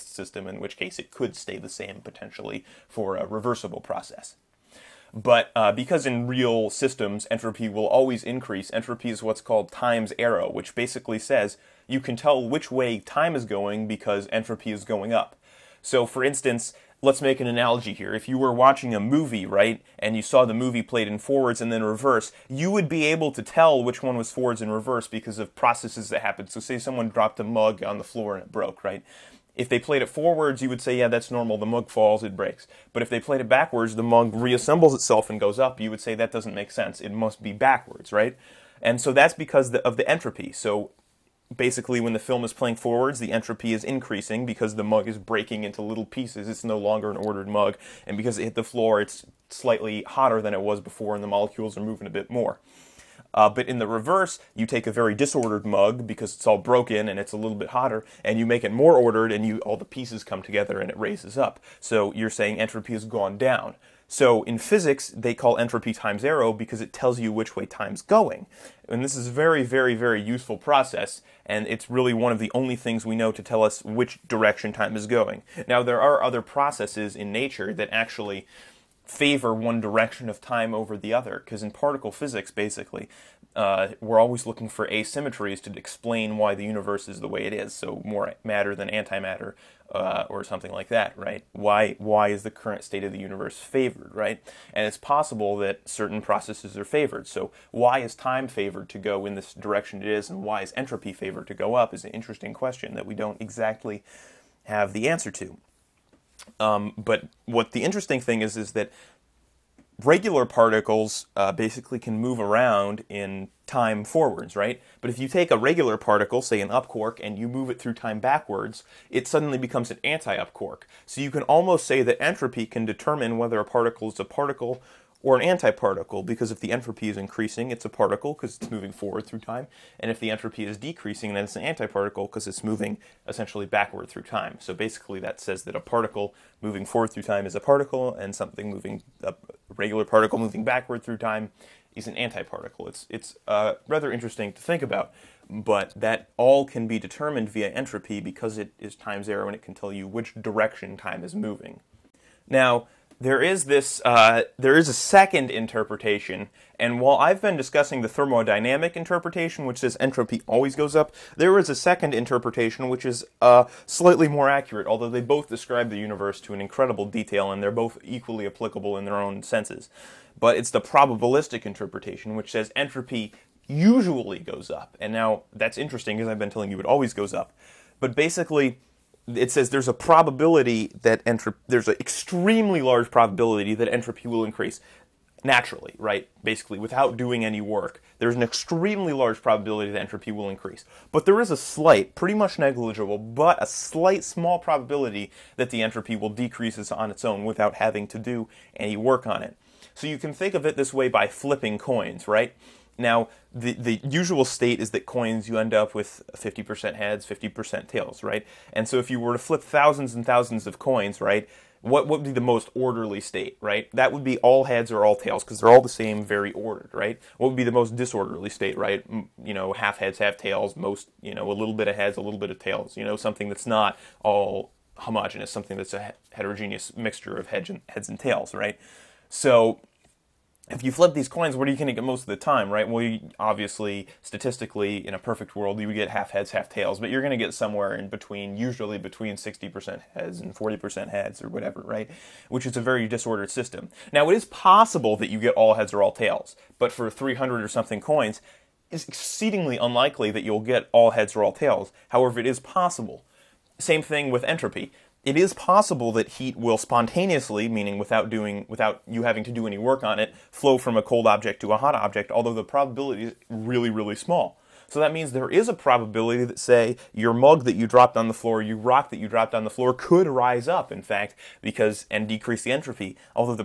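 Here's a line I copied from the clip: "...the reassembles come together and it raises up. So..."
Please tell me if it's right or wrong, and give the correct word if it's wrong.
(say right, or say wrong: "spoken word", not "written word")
wrong: "pieces", not "reassembles".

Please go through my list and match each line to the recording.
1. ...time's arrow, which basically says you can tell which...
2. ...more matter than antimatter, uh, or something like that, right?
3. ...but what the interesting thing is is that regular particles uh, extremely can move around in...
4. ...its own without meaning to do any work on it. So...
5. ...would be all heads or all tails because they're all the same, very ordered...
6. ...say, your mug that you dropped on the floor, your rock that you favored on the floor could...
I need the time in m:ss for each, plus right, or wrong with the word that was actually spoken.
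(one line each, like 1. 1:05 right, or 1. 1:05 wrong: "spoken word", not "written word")
1. 0:09 right
2. 1:28 right
3. 1:46 wrong: "basically", not "extremely"
4. 3:17 wrong: "having", not "meaning"
5. 3:34 right
6. 4:26 wrong: "dropped", not "favored".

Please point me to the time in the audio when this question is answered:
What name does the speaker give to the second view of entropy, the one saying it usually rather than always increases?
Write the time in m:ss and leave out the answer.
2:50.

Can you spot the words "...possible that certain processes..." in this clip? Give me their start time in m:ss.
1:34.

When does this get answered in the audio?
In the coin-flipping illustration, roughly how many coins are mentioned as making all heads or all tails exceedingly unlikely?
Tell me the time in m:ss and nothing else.
4:07.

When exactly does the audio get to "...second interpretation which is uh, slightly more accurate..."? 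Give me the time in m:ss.
2:41.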